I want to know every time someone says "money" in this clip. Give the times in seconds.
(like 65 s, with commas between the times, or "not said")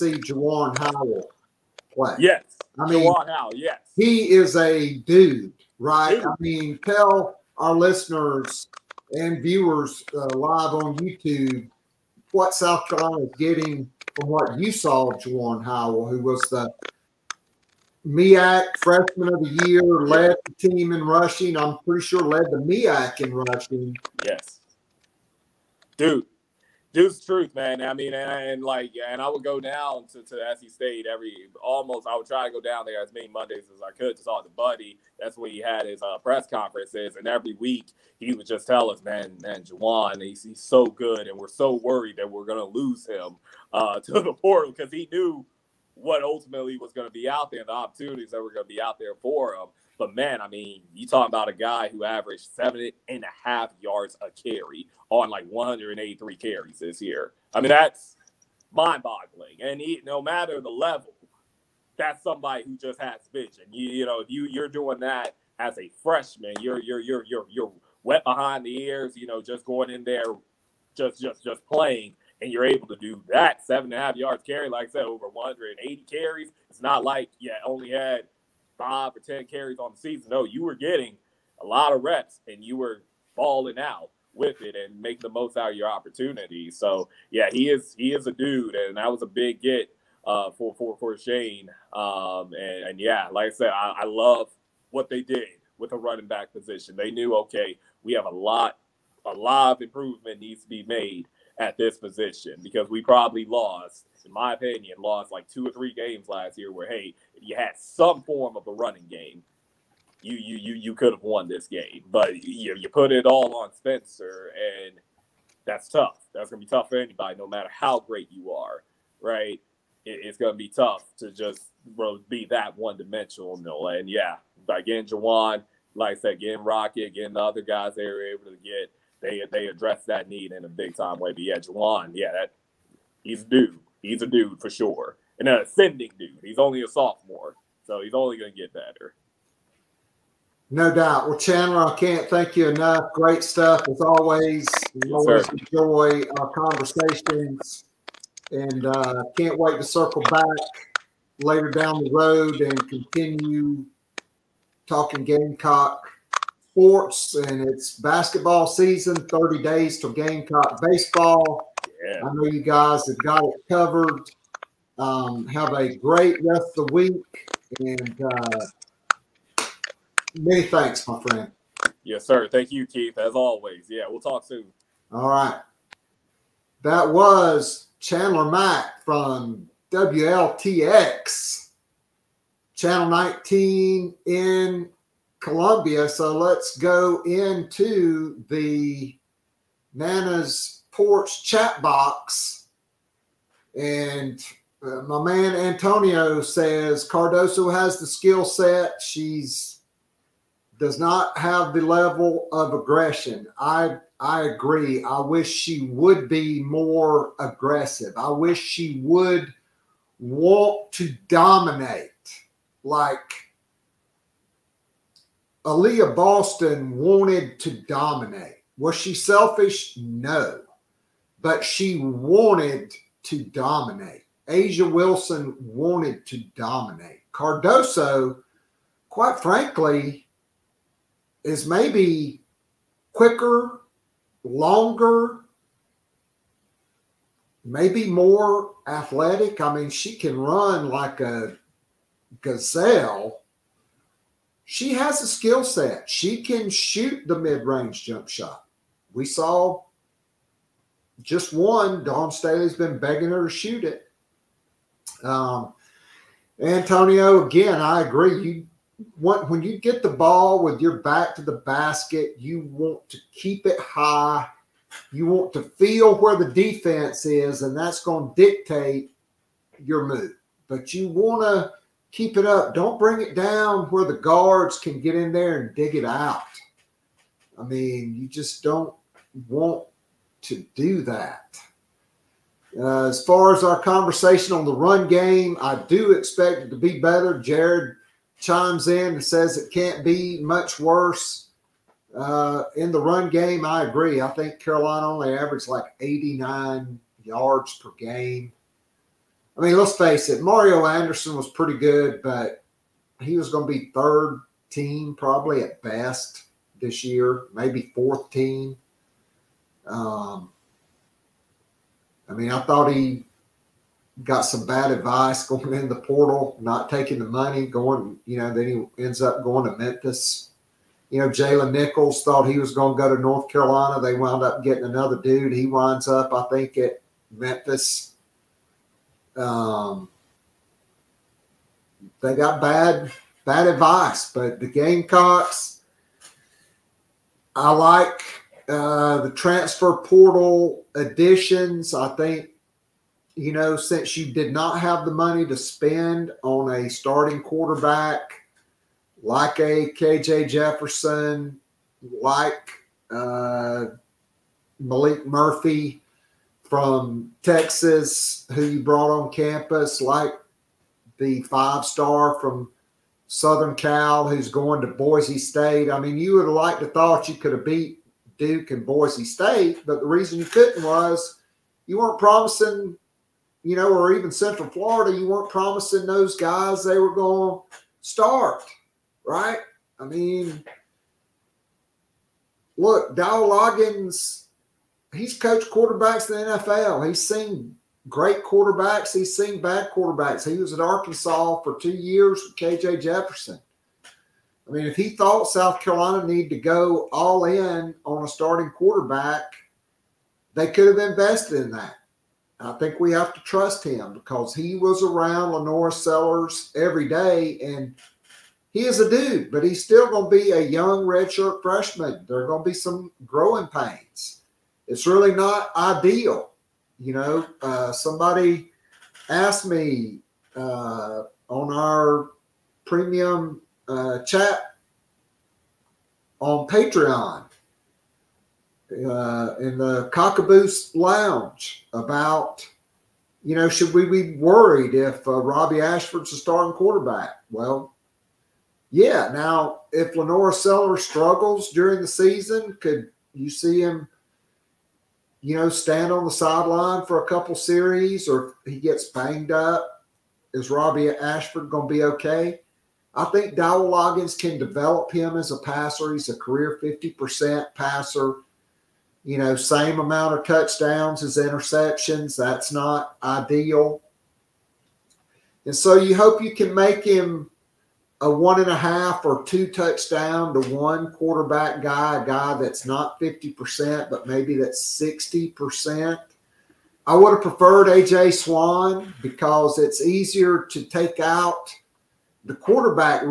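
317 s, 345 s.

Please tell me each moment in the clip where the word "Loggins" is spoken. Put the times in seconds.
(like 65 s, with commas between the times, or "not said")
383 s, 453 s.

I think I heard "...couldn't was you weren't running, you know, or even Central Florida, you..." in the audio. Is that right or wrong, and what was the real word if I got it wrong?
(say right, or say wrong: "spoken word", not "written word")
wrong: "promising", not "running".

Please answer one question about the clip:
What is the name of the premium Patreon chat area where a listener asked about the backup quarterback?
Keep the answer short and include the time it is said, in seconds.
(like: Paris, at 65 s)
Cockaboose Lounge, at 430 s.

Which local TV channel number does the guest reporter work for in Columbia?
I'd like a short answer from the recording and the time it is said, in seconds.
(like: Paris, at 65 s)
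19, at 183 s.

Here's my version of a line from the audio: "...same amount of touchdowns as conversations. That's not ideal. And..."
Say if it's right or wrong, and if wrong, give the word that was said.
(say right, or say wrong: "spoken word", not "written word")
wrong: "interceptions", not "conversations".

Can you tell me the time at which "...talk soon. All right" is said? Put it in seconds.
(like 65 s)
174 s.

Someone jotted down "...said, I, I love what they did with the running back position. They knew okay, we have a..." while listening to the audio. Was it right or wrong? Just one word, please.
right.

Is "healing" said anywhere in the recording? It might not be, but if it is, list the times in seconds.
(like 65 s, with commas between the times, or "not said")
not said.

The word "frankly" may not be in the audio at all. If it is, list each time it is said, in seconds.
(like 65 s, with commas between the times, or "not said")
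229 s.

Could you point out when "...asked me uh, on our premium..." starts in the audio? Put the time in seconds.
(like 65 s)
419 s.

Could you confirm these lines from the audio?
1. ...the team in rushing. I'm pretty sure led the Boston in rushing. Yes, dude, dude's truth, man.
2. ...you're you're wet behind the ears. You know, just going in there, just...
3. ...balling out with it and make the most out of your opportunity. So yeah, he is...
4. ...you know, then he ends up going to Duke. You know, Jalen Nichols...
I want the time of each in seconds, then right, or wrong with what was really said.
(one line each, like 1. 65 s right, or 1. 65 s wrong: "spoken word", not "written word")
1. 20 s wrong: "MEAC", not "Boston"
2. 67 s right
3. 83 s right
4. 318 s wrong: "Memphis", not "Duke".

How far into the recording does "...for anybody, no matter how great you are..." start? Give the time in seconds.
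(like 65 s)
116 s.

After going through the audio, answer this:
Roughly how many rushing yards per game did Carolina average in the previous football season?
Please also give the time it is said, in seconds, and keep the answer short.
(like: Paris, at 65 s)
89, at 295 s.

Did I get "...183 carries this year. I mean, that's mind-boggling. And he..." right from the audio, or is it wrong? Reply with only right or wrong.
right.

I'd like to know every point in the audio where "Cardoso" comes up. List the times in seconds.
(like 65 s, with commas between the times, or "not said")
197 s, 227 s.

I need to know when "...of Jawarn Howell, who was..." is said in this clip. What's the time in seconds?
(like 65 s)
15 s.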